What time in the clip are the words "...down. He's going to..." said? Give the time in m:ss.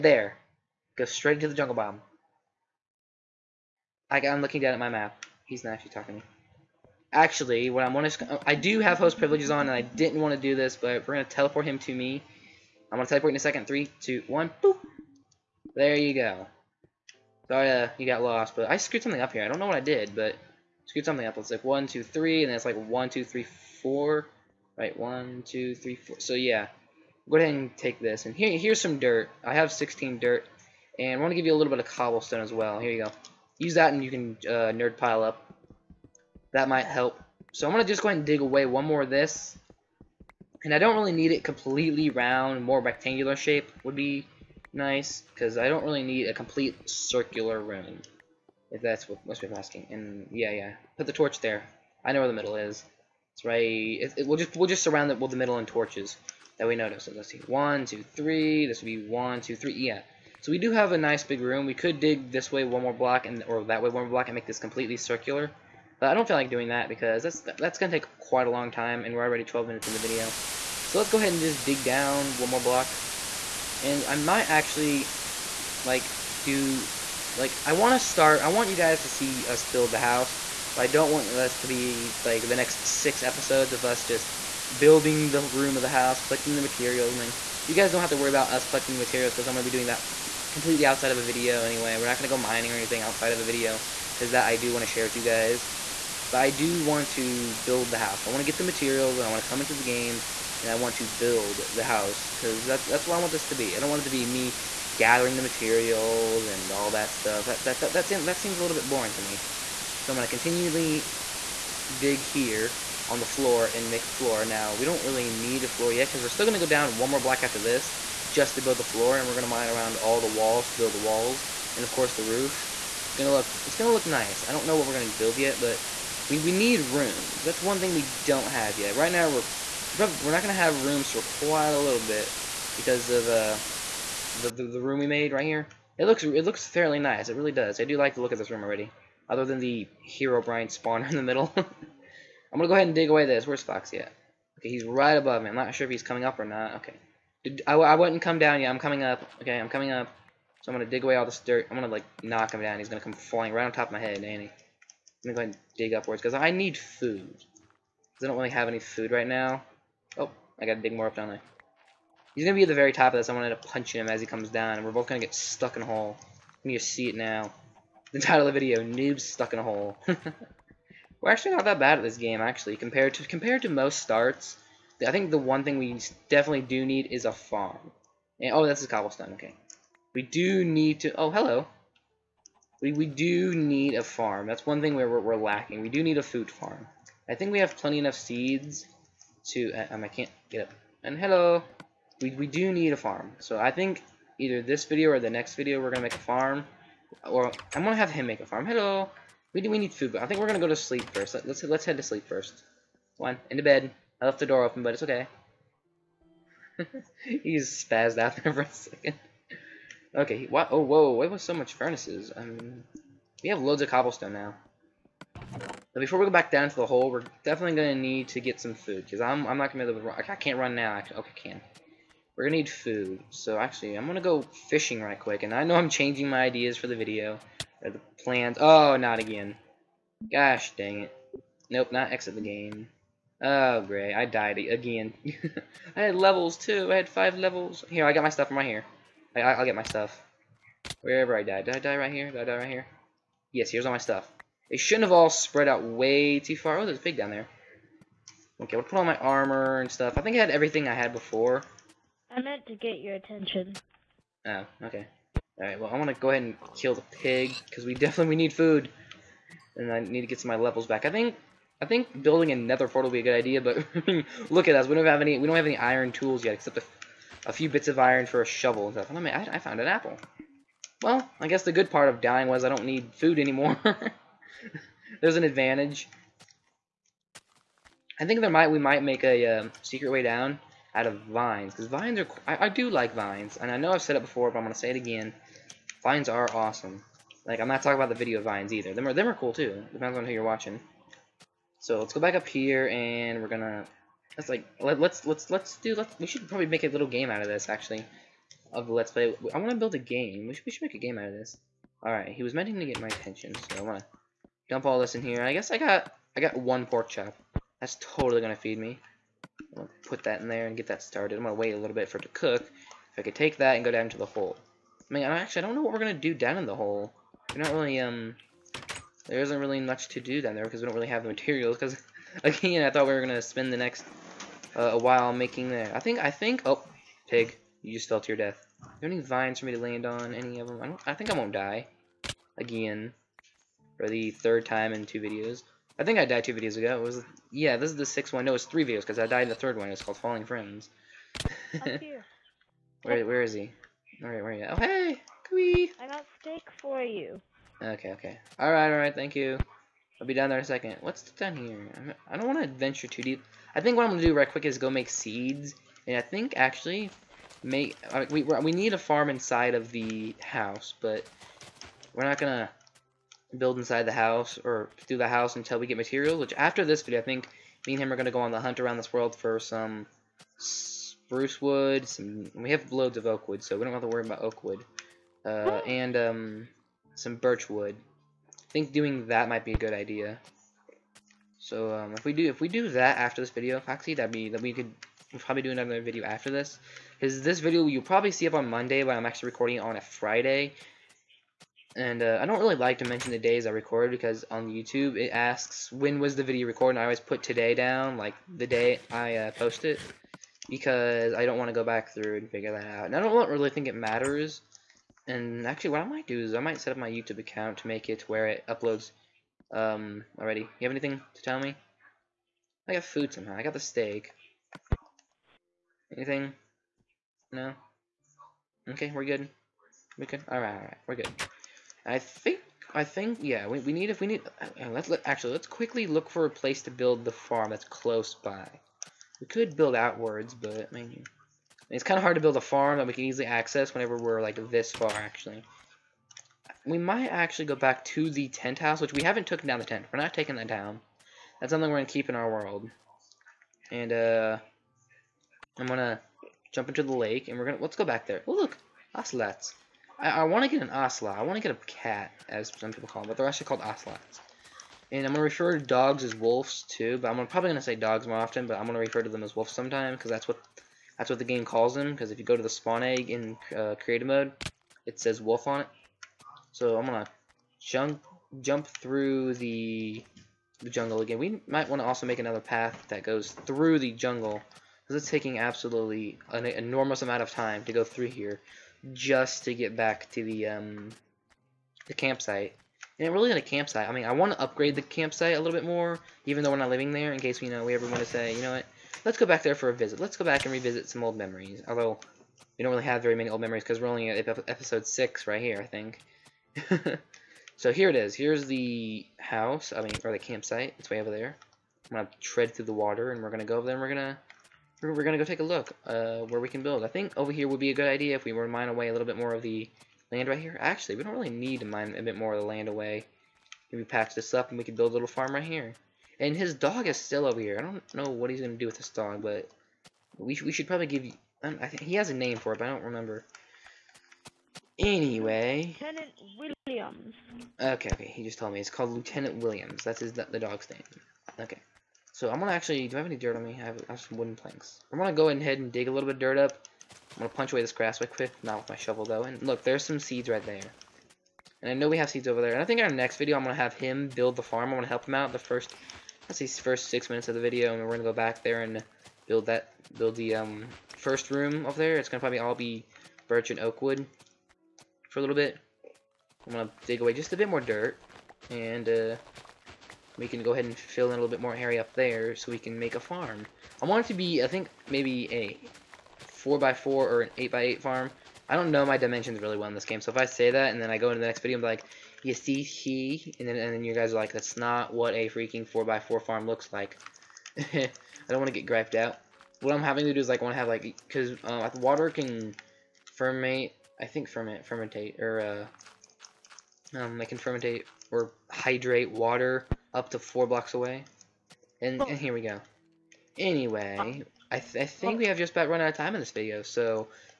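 2:32.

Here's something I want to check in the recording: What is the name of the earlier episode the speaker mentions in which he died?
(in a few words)
Falling Friends.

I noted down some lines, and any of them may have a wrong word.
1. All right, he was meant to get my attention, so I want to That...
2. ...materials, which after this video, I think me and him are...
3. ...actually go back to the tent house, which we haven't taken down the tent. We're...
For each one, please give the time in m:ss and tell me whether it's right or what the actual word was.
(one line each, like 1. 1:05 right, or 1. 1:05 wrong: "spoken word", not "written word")
1. 5:02 wrong: "Dump", not "That"
2. 6:05 right
3. 7:17 right.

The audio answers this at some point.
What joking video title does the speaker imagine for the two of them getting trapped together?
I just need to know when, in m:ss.
2:48.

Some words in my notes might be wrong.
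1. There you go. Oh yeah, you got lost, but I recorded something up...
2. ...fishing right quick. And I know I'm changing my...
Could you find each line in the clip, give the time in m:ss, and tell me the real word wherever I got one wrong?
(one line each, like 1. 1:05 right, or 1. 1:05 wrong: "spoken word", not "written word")
1. 0:15 wrong: "screwed", not "recorded"
2. 3:44 right.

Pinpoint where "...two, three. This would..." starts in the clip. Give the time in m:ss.
0:57.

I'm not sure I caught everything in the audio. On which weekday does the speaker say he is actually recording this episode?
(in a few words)
Friday.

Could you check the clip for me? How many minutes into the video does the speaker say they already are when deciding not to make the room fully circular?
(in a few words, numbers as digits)
12.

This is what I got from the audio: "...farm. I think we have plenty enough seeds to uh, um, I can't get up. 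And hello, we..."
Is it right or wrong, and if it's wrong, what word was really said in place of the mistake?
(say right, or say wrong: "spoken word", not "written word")
right.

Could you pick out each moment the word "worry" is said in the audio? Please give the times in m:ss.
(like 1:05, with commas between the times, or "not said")
1:28, 6:14.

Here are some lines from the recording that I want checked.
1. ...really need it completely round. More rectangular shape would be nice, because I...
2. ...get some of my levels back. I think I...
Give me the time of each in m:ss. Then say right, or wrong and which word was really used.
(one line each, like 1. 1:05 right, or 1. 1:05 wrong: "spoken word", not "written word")
1. 0:40 right
2. 4:20 right.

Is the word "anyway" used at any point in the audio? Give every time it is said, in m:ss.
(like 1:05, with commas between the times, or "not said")
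1:31, 8:44, 9:53.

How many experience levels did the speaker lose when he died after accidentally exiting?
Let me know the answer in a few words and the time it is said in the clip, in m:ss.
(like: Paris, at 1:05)
5, at 3:57.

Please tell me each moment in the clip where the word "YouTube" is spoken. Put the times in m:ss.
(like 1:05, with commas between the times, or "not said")
6:34, 6:47.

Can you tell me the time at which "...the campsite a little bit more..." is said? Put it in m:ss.
8:04.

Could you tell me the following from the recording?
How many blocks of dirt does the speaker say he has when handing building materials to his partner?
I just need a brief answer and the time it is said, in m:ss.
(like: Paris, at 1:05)
16, at 0:29.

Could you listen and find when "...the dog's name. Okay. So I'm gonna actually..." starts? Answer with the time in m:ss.
8:50.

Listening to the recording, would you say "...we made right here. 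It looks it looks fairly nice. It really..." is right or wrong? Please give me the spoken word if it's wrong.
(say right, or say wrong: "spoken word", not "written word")
right.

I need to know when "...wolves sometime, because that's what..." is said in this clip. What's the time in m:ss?
7:39.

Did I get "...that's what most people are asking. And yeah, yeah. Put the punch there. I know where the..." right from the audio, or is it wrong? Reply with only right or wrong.
wrong.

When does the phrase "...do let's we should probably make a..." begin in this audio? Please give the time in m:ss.
4:55.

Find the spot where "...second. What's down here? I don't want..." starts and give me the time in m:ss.
5:50.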